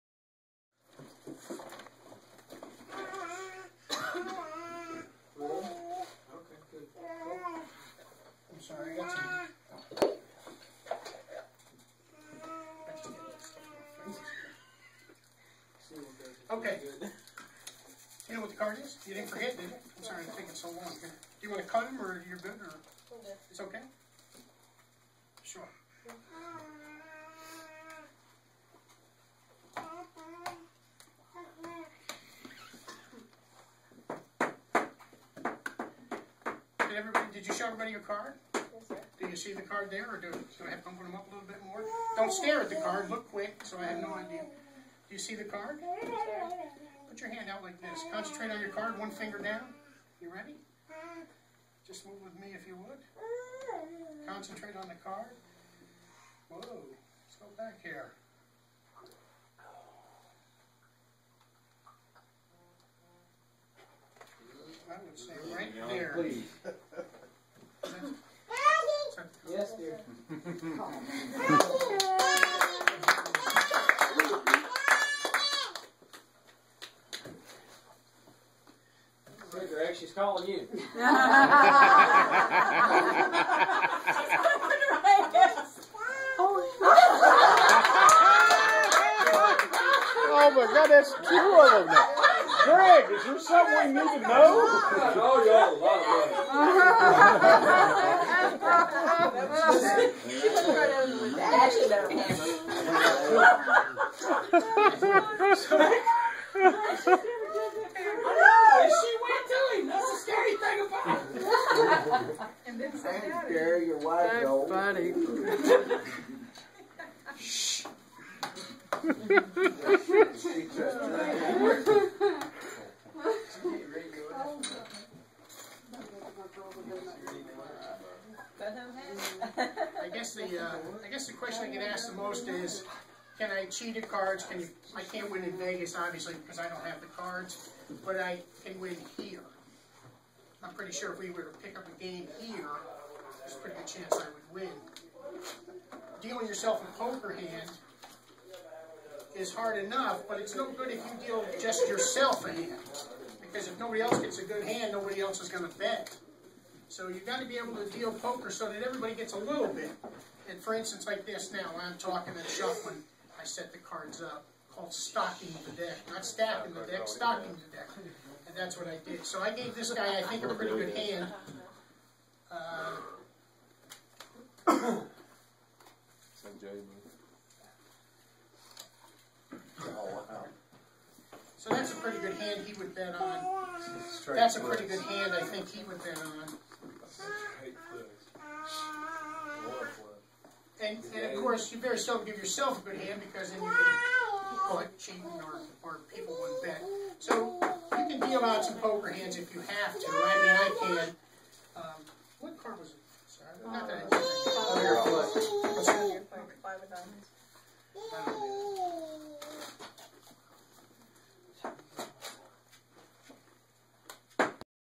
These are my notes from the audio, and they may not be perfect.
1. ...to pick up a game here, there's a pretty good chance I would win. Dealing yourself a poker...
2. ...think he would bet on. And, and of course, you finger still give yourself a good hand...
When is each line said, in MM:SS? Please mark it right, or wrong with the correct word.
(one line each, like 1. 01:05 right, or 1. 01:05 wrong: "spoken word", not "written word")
1. 02:21 right
2. 03:05 wrong: "better", not "finger".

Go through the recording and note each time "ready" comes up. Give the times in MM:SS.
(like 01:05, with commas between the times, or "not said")
00:50.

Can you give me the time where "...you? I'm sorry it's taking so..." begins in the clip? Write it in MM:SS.
00:19.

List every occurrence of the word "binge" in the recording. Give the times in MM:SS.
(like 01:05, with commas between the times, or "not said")
not said.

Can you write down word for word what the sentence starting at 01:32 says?
Greg, is there something we need to know?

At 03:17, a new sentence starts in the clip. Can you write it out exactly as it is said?
So you can deal out some poker hands if you have to.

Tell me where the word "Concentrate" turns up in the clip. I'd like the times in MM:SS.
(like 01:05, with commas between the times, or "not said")
00:48, 00:54.